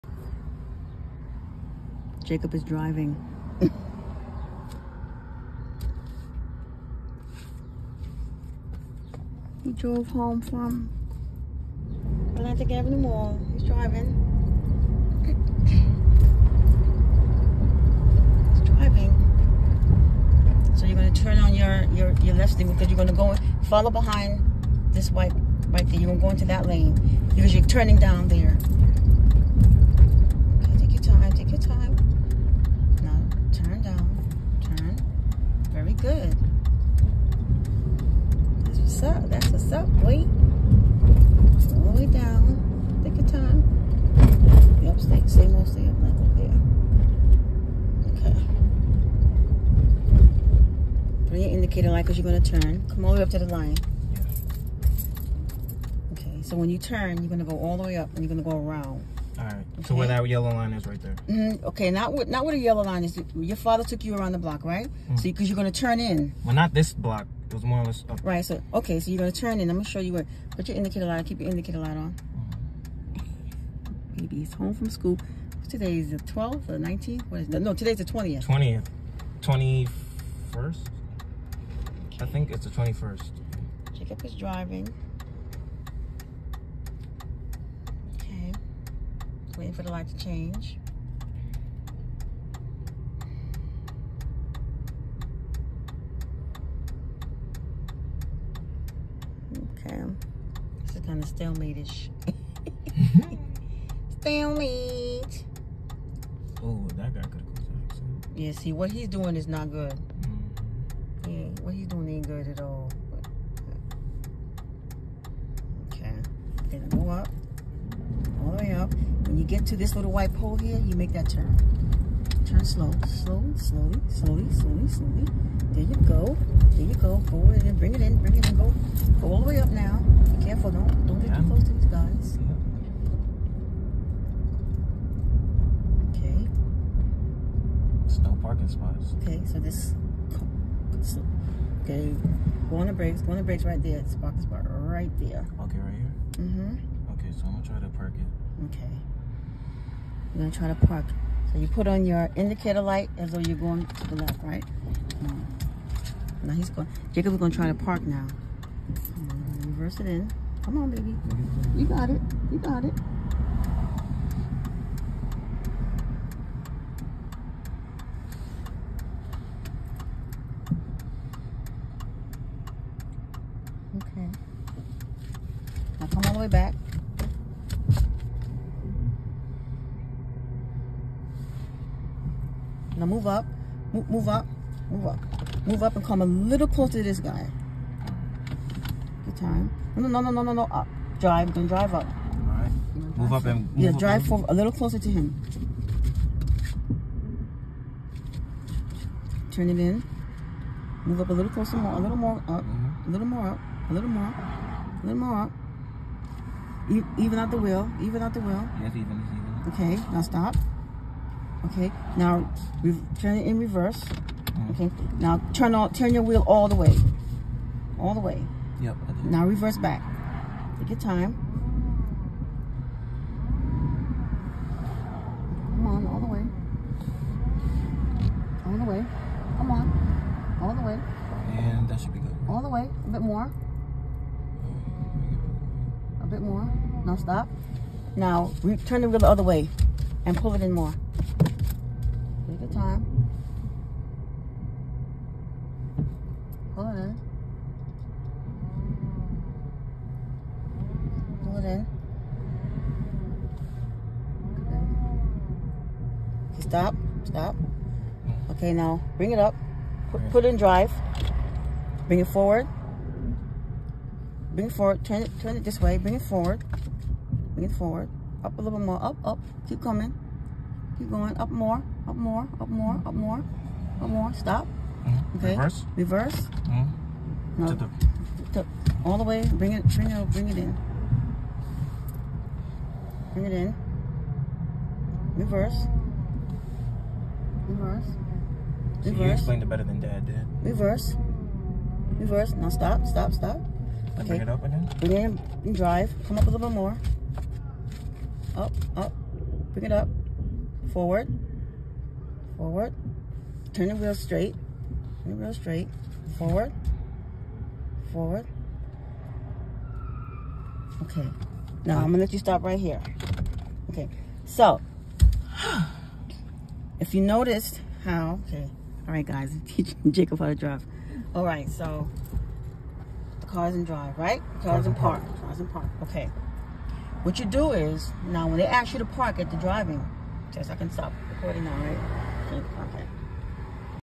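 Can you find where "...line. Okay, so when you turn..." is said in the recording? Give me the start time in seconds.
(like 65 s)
53 s.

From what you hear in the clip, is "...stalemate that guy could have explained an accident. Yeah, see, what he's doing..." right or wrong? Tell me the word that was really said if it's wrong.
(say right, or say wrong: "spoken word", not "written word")
wrong: "caused", not "explained".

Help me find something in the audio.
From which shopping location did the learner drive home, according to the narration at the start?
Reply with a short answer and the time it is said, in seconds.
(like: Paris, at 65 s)
Atlantic Avenue Mall, at 12 s.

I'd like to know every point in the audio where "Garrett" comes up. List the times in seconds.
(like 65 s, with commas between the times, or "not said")
not said.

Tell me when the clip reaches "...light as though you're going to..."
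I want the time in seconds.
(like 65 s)
152 s.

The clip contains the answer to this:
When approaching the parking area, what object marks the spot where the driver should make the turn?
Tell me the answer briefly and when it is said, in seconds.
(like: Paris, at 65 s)
little white pole, at 119 s.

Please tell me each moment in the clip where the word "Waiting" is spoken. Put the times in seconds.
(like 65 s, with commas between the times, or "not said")
89 s.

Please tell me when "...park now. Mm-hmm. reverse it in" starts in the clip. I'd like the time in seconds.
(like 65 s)
157 s.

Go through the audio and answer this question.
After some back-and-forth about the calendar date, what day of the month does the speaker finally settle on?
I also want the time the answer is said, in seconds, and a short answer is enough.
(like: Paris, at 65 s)
21st, at 82 s.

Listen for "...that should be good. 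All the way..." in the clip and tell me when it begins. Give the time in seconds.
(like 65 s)
231 s.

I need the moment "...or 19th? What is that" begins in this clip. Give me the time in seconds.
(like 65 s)
76 s.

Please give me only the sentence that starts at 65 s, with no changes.
Mm So because you, are gonna turn in.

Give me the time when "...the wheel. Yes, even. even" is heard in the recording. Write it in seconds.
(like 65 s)
208 s.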